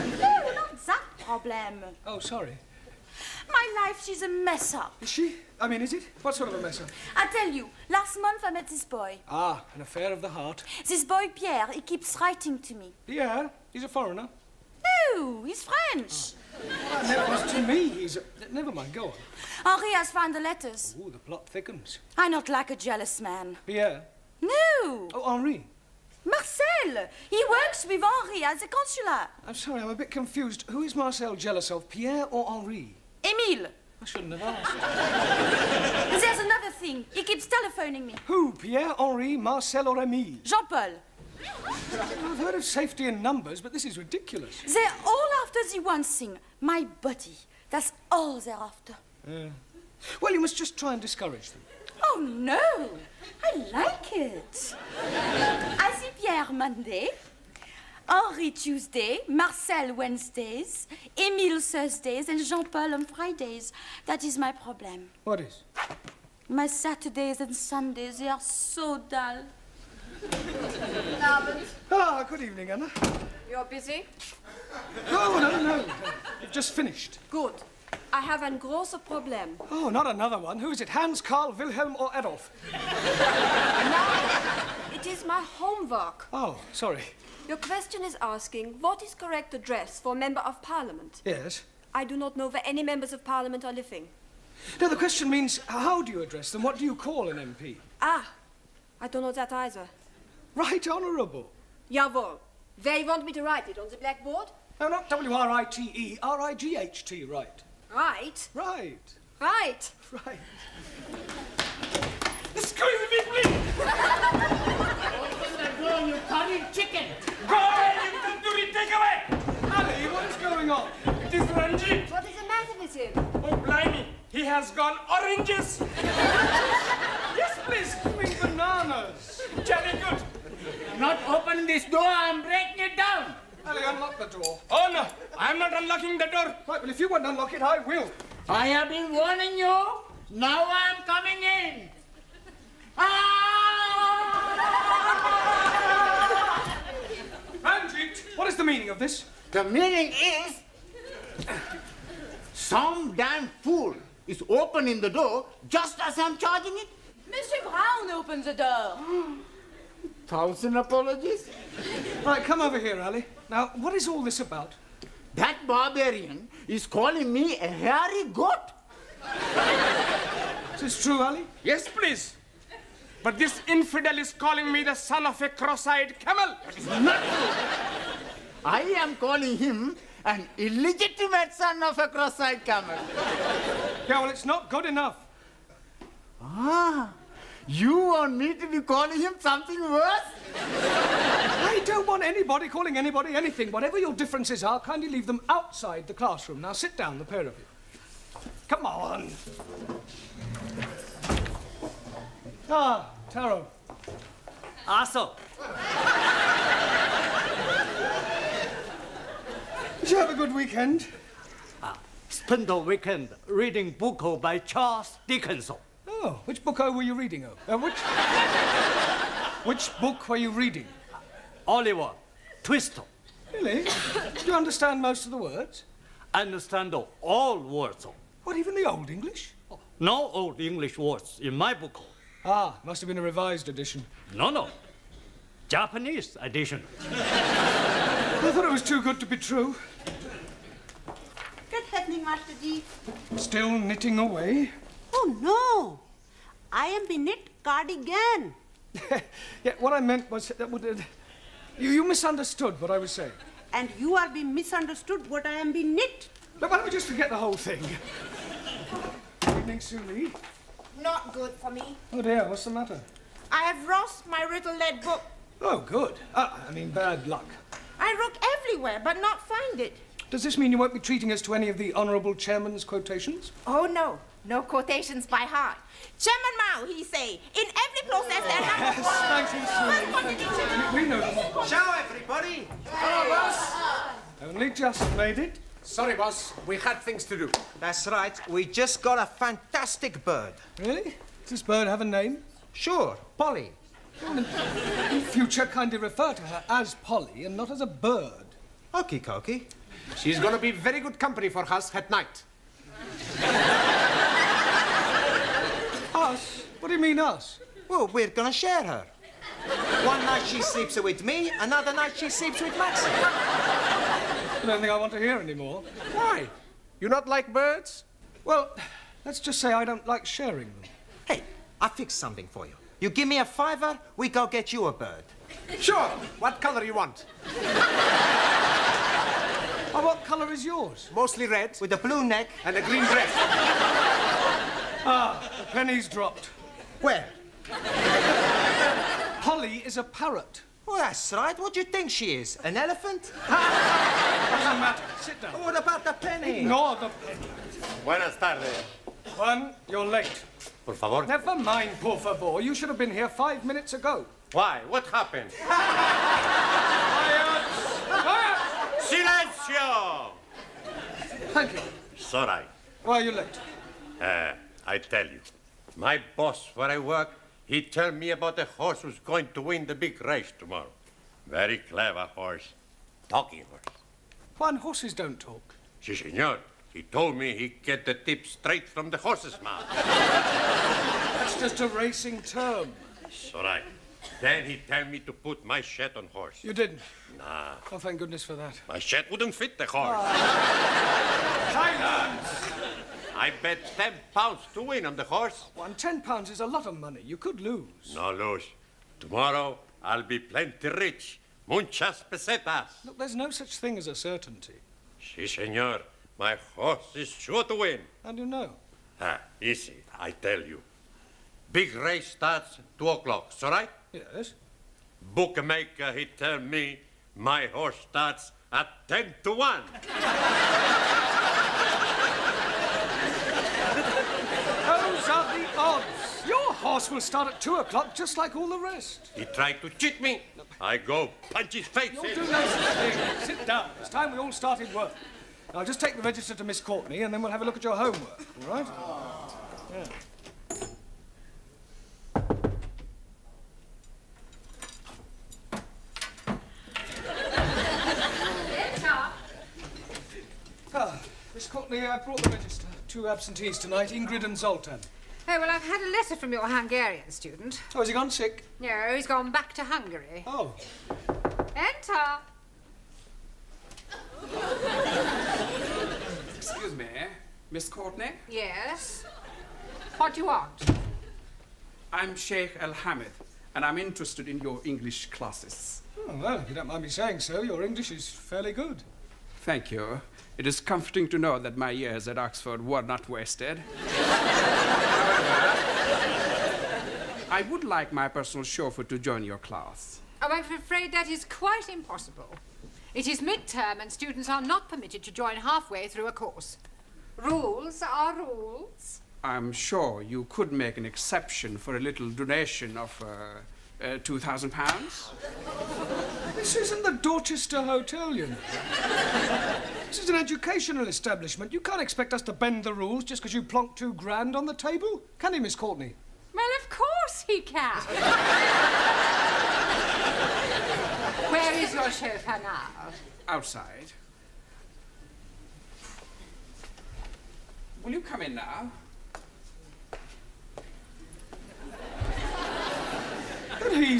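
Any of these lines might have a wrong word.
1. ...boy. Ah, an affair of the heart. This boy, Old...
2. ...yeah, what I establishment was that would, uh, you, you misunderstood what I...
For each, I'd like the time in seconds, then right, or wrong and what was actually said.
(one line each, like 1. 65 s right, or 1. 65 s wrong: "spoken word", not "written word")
1. 8 s wrong: "Pierre", not "Old"
2. 249 s wrong: "meant", not "establishment".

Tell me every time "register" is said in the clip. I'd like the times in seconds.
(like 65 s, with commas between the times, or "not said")
436 s, 452 s.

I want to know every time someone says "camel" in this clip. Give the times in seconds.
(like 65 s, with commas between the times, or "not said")
176 s, 182 s.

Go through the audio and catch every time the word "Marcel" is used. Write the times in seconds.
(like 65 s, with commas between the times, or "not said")
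26 s, 30 s, 39 s, 59 s.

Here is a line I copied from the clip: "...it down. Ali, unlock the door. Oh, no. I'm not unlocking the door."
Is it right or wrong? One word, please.
right.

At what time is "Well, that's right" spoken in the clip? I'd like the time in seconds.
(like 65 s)
340 s.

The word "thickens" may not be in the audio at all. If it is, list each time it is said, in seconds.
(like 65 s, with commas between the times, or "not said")
21 s.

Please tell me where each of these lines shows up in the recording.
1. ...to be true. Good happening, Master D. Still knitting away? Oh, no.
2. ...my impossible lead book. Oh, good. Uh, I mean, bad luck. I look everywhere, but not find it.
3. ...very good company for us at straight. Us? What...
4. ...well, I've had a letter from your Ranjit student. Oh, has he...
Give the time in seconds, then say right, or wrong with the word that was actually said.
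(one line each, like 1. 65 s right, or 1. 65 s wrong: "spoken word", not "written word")
1. 239 s right
2. 264 s wrong: "riddle", not "impossible"
3. 300 s wrong: "night", not "straight"
4. 455 s wrong: "Hungarian", not "Ranjit".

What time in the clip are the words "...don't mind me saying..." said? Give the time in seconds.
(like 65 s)
476 s.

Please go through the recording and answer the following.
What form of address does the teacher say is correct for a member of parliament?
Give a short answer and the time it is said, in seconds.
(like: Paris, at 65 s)
Right Honourable, at 100 s.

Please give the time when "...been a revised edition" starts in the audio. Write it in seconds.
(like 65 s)
233 s.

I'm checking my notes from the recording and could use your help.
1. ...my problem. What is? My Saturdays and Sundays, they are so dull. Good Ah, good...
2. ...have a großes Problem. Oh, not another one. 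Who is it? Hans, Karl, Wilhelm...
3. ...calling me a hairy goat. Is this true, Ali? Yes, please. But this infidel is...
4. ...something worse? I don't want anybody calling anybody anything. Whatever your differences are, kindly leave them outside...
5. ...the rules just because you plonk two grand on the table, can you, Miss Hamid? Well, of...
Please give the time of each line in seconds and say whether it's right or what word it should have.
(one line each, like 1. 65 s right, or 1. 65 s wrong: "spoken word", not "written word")
1. 64 s right
2. 78 s right
3. 166 s right
4. 189 s right
5. 512 s wrong: "Courtney", not "Hamid".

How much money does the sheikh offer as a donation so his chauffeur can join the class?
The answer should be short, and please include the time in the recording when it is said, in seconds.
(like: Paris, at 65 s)
£2,000, at 504 s.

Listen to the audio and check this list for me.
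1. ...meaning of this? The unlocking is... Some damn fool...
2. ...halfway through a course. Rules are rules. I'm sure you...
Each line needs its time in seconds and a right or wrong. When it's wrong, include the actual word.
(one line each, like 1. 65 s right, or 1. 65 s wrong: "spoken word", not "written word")
1. 148 s wrong: "meaning", not "unlocking"
2. 495 s right.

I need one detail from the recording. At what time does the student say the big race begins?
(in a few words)
2 o'clock.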